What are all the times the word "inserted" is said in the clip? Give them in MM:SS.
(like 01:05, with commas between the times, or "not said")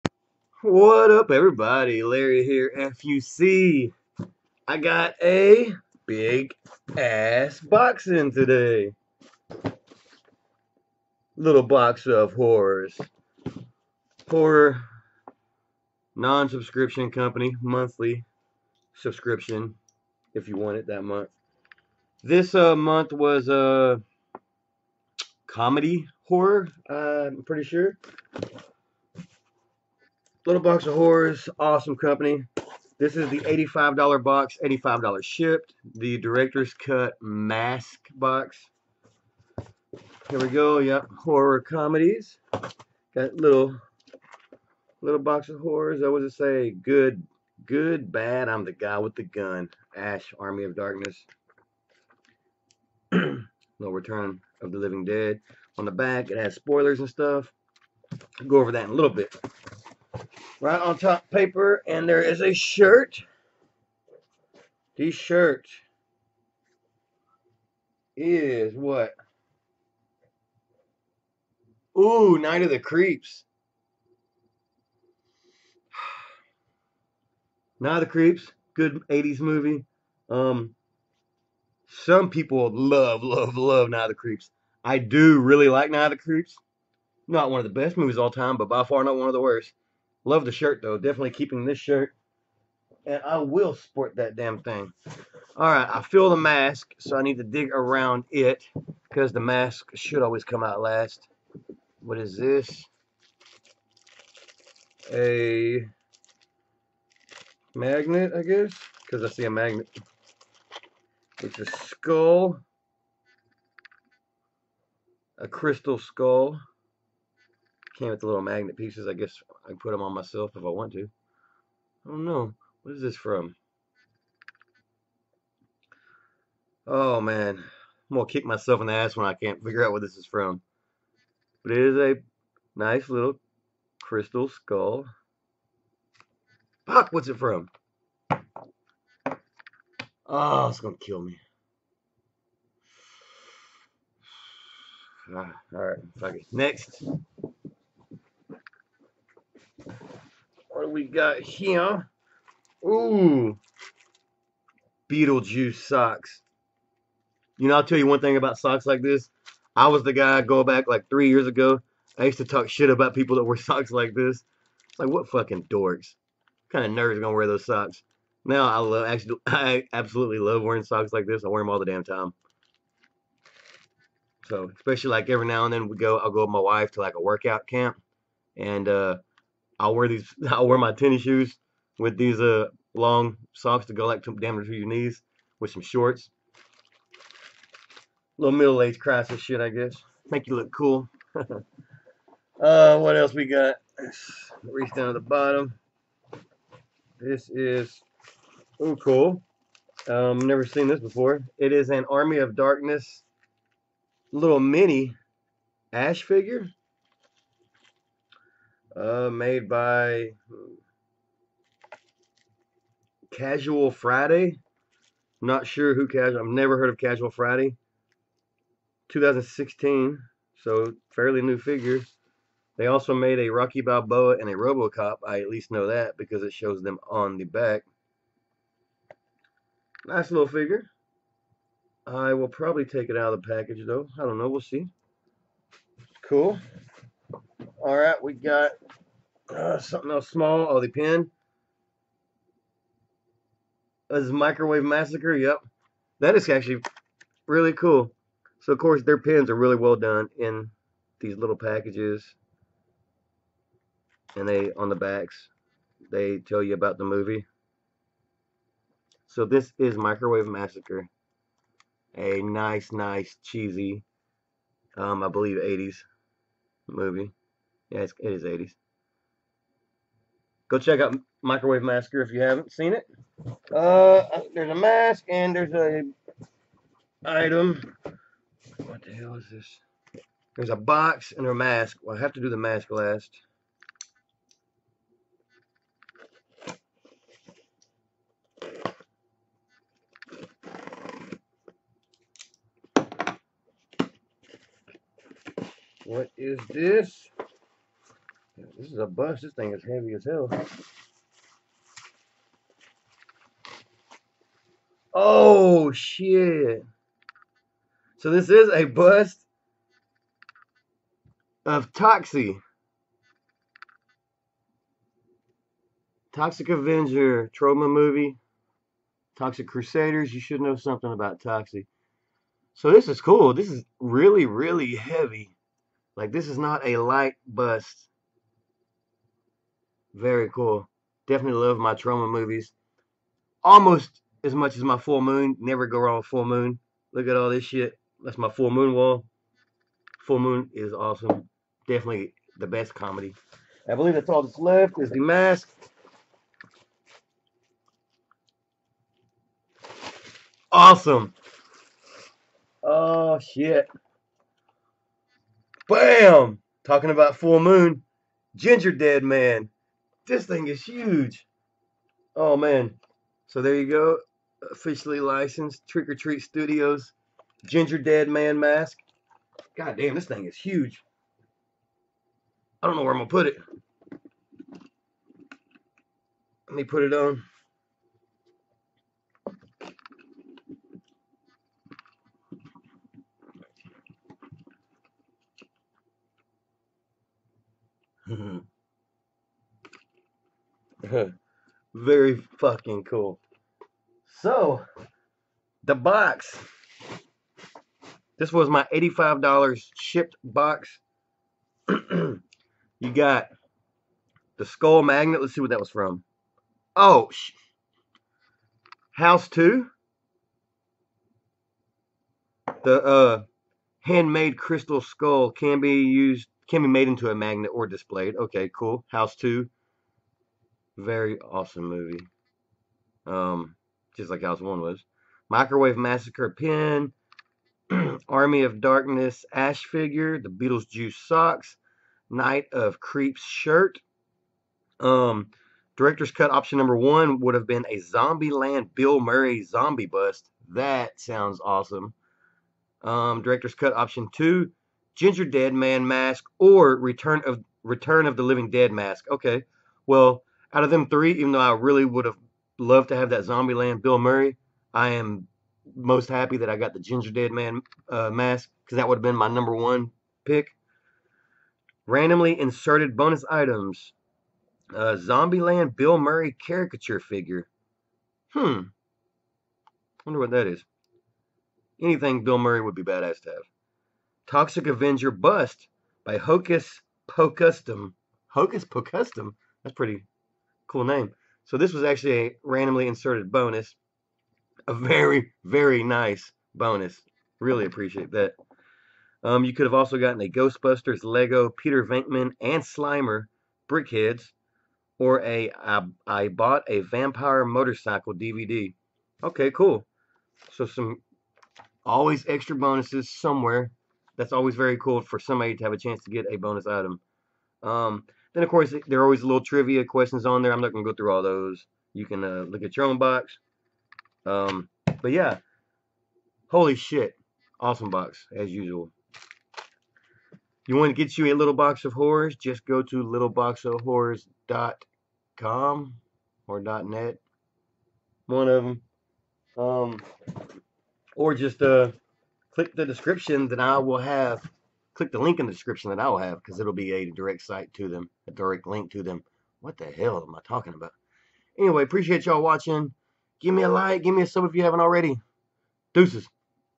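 07:42, 08:03.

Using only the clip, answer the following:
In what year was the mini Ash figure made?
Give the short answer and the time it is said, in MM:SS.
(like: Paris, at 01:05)
2016, at 03:39.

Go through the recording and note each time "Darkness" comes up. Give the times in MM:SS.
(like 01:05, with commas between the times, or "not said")
00:50, 03:22, 07:08.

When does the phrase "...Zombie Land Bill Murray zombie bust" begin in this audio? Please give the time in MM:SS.
07:17.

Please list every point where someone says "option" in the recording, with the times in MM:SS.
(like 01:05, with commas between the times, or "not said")
07:16, 07:23.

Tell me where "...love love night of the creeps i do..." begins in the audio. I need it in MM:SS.
01:23.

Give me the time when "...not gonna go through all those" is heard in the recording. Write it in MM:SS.
08:30.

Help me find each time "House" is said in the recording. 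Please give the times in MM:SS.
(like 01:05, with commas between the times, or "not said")
06:49, 06:59, 07:04.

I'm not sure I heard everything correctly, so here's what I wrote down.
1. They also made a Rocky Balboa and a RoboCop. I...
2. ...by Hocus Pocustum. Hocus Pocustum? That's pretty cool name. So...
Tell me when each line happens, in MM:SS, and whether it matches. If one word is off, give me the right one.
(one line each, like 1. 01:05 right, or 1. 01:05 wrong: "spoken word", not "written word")
1. 03:42 right
2. 07:56 right.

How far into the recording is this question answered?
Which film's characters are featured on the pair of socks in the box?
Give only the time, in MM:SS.
02:35.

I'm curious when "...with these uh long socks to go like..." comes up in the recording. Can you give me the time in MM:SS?
03:01.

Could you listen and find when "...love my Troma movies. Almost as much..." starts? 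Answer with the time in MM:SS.
05:31.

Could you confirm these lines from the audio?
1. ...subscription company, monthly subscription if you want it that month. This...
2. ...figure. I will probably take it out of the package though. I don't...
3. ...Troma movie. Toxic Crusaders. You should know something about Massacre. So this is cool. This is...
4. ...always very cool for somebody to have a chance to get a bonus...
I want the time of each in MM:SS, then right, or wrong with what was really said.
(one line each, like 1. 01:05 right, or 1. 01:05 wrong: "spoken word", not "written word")
1. 00:16 right
2. 03:50 right
3. 05:17 wrong: "Toxic", not "Massacre"
4. 08:24 right.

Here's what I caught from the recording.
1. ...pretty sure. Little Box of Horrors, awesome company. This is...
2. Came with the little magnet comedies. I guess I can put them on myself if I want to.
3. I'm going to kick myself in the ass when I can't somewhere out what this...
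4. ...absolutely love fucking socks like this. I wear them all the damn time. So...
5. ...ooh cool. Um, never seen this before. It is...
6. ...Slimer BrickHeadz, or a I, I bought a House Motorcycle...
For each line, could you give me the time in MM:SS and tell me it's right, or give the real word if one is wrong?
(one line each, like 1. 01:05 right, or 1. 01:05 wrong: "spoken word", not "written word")
1. 00:27 right
2. 01:58 wrong: "pieces", not "comedies"
3. 02:07 wrong: "figure", not "somewhere"
4. 02:49 wrong: "wearing", not "fucking"
5. 03:18 right
6. 08:12 wrong: "Vampire", not "House".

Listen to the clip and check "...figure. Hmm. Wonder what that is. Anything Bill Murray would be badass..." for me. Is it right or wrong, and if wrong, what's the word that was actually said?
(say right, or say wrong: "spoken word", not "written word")
right.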